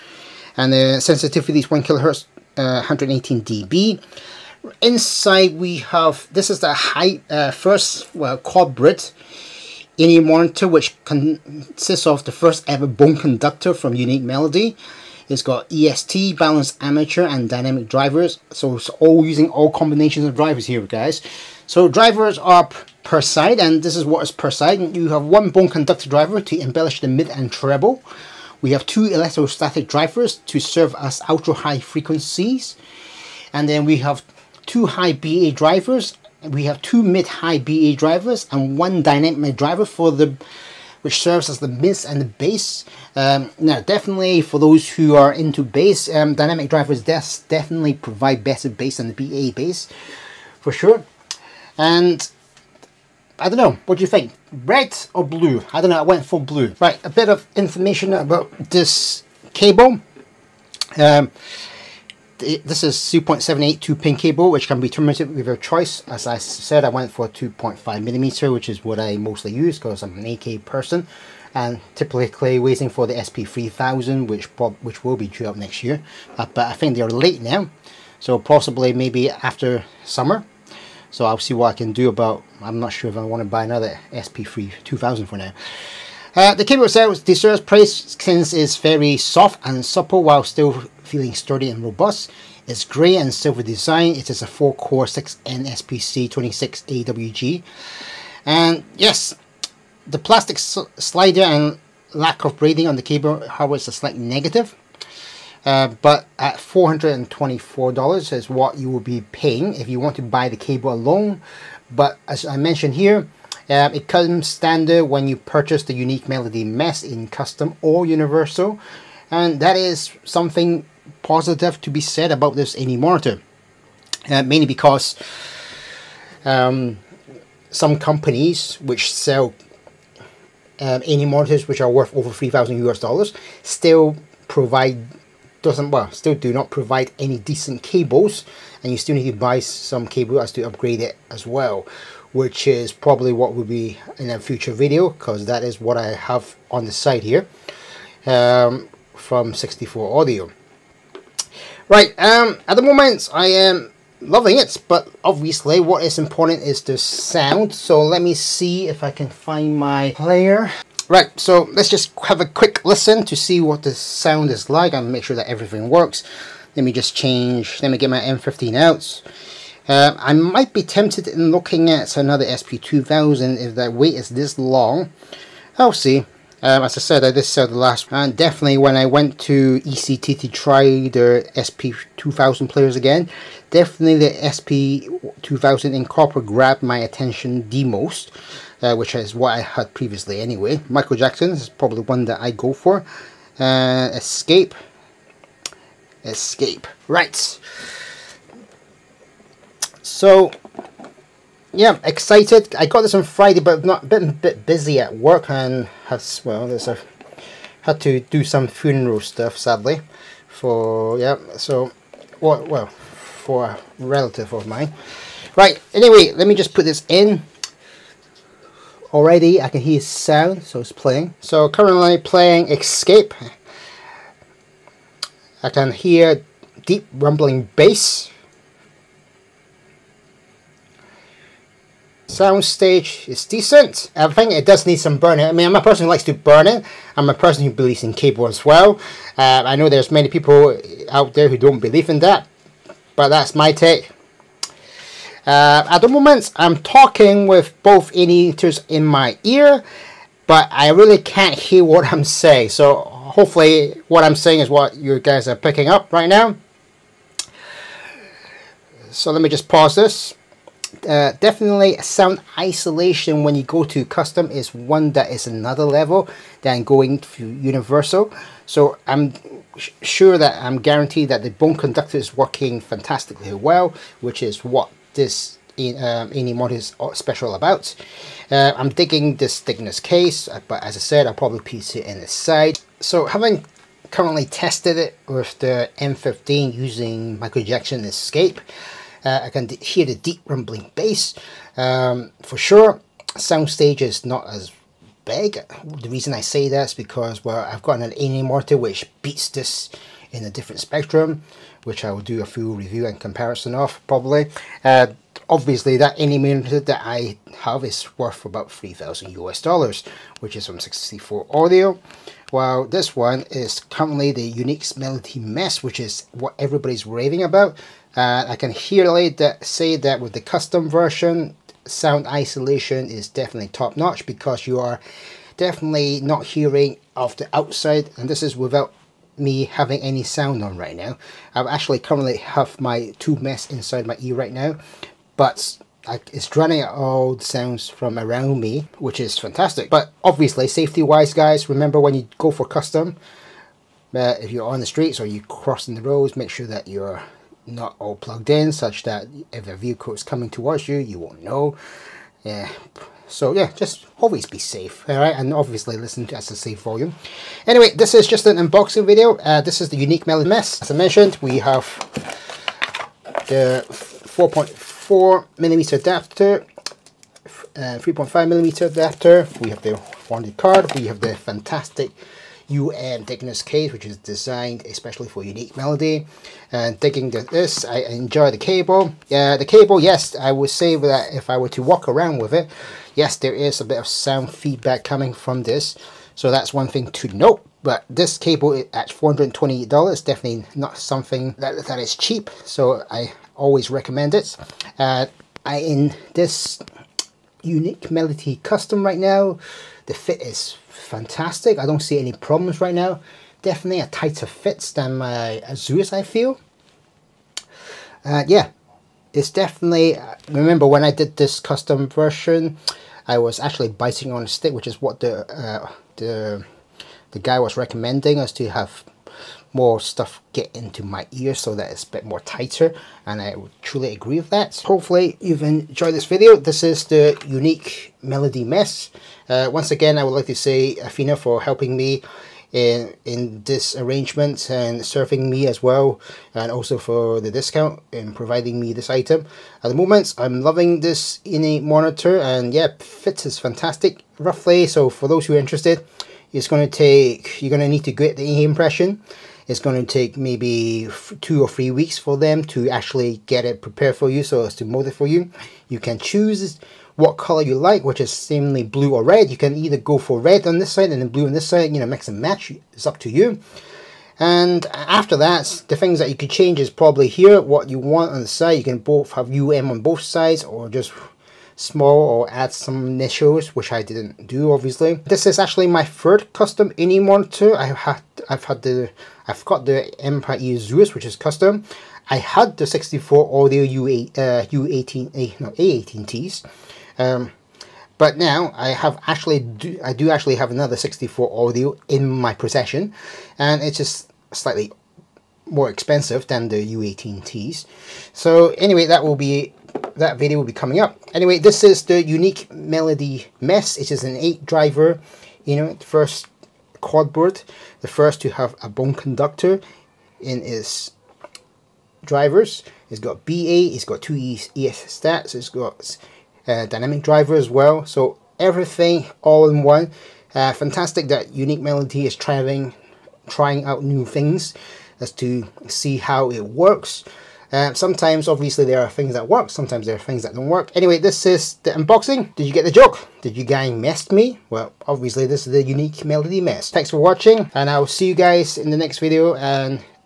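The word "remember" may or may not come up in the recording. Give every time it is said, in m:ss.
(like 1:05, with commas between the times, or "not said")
5:41, 6:50.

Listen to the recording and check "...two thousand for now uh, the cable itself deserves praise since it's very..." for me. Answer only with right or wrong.
right.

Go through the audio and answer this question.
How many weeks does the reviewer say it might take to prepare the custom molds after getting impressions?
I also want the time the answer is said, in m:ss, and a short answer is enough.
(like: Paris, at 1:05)
2 or 3 weeks, at 7:31.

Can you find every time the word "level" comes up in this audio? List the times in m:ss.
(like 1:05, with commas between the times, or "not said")
4:25.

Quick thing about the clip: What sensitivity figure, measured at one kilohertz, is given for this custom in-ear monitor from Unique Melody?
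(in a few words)
118 dB.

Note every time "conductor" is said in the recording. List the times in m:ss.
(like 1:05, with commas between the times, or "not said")
0:13, 0:25, 4:31, 8:29.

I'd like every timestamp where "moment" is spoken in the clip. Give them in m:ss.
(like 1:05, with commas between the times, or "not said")
2:32, 4:06, 7:19.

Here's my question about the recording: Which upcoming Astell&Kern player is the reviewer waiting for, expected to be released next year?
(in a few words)
SP3000.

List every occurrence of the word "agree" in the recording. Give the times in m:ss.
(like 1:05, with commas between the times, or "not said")
7:04.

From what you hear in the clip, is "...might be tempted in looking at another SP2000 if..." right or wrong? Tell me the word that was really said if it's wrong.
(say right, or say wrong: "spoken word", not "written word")
right.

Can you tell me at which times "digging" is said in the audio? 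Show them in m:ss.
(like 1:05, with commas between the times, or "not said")
4:38.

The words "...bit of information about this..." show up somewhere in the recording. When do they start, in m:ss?
0:57.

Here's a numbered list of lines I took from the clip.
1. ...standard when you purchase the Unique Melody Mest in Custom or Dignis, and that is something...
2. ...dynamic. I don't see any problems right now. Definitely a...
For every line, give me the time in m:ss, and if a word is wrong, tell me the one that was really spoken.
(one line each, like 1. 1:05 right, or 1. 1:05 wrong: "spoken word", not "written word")
1. 1:54 wrong: "Universal", not "Dignis"
2. 6:40 wrong: "fantastic", not "dynamic".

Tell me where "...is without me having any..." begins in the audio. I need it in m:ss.
5:28.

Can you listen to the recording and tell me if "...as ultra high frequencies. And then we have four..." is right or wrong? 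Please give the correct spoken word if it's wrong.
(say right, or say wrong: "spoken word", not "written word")
wrong: "two", not "four".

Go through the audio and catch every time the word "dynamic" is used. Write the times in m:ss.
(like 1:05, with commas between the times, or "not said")
0:17, 0:39, 0:46, 8:36.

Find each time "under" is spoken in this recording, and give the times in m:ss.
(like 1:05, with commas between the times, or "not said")
not said.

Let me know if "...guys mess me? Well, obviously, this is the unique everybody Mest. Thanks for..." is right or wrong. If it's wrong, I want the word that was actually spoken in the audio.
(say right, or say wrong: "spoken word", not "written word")
wrong: "melody", not "everybody".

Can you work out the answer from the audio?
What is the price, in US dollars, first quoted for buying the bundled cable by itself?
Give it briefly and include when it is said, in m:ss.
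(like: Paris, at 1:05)
$424, at 1:46.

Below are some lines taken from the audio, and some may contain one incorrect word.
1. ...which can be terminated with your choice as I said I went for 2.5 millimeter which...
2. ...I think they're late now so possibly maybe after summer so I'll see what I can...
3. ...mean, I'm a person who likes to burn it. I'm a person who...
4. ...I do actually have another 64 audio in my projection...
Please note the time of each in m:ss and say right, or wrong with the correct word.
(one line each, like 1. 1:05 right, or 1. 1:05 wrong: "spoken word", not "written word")
1. 1:04 right
2. 1:16 right
3. 3:55 right
4. 8:10 wrong: "possession", not "projection".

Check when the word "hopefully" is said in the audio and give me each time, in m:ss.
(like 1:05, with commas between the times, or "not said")
4:13, 7:04.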